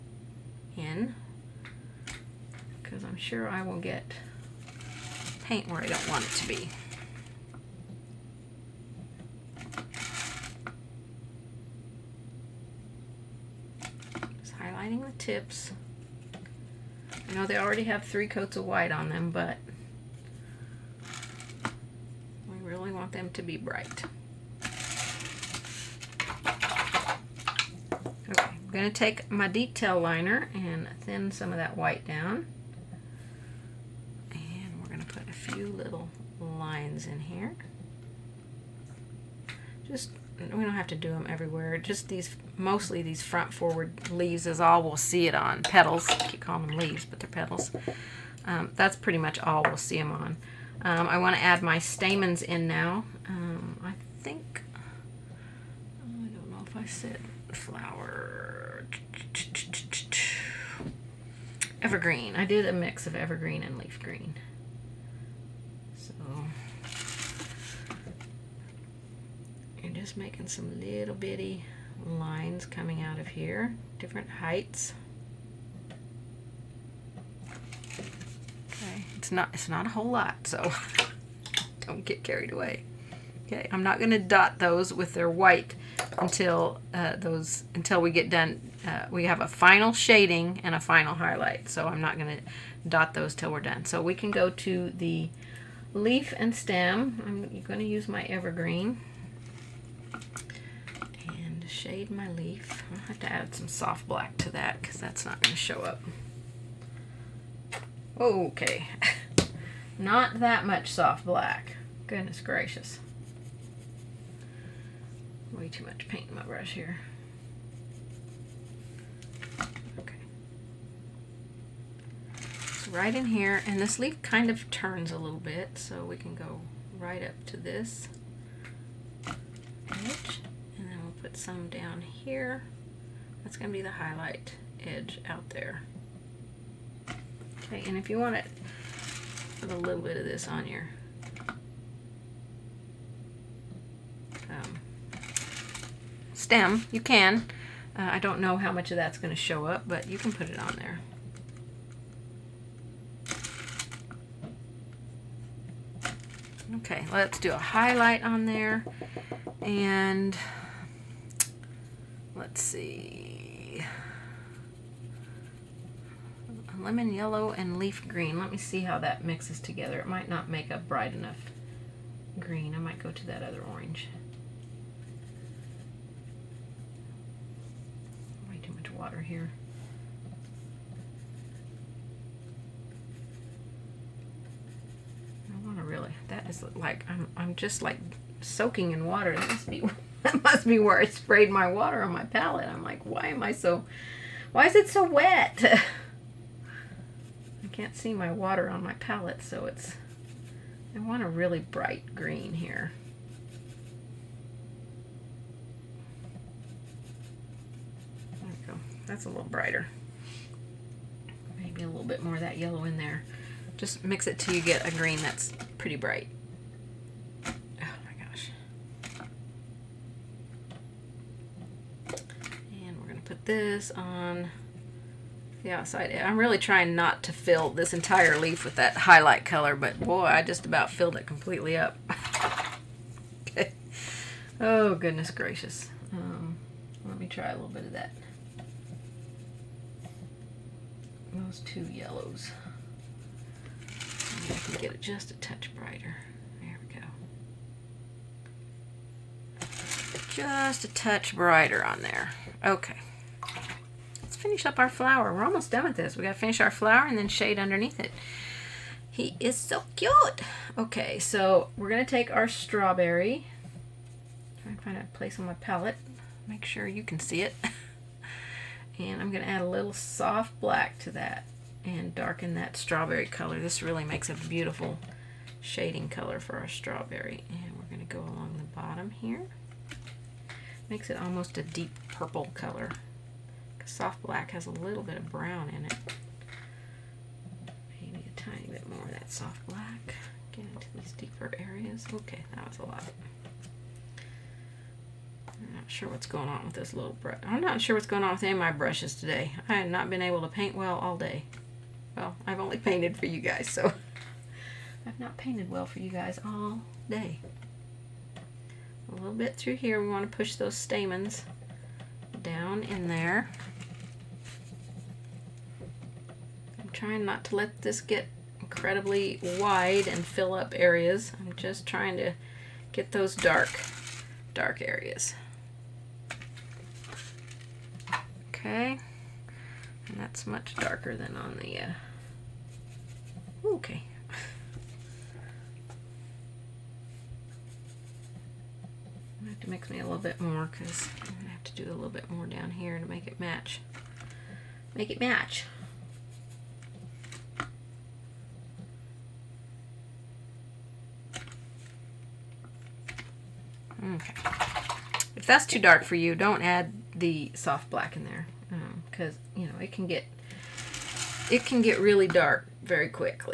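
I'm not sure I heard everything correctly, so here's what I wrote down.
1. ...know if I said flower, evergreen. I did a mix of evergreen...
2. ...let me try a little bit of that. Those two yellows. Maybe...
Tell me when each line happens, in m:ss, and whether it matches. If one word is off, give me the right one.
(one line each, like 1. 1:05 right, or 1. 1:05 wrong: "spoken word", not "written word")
1. 0:56 right
2. 3:57 right.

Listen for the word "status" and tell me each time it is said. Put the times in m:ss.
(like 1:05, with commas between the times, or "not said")
not said.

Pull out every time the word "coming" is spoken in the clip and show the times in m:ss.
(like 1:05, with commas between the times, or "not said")
1:12.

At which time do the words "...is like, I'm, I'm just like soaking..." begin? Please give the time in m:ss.
3:06.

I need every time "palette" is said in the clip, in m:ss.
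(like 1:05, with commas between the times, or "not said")
3:12, 3:18, 4:25.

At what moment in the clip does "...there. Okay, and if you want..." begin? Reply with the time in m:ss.
2:15.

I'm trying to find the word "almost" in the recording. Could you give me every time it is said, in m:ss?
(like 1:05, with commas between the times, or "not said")
4:15, 4:41.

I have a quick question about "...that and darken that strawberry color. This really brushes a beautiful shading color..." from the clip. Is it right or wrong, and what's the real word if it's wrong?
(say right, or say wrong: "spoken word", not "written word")
wrong: "makes", not "brushes".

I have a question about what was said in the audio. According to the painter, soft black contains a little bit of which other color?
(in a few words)
brown.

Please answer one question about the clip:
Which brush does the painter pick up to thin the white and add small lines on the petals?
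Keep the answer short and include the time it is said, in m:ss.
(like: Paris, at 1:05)
detail liner, at 0:29.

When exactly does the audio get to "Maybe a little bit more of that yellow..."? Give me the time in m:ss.
3:31.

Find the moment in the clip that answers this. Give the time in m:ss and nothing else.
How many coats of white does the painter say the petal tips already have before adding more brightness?
0:18.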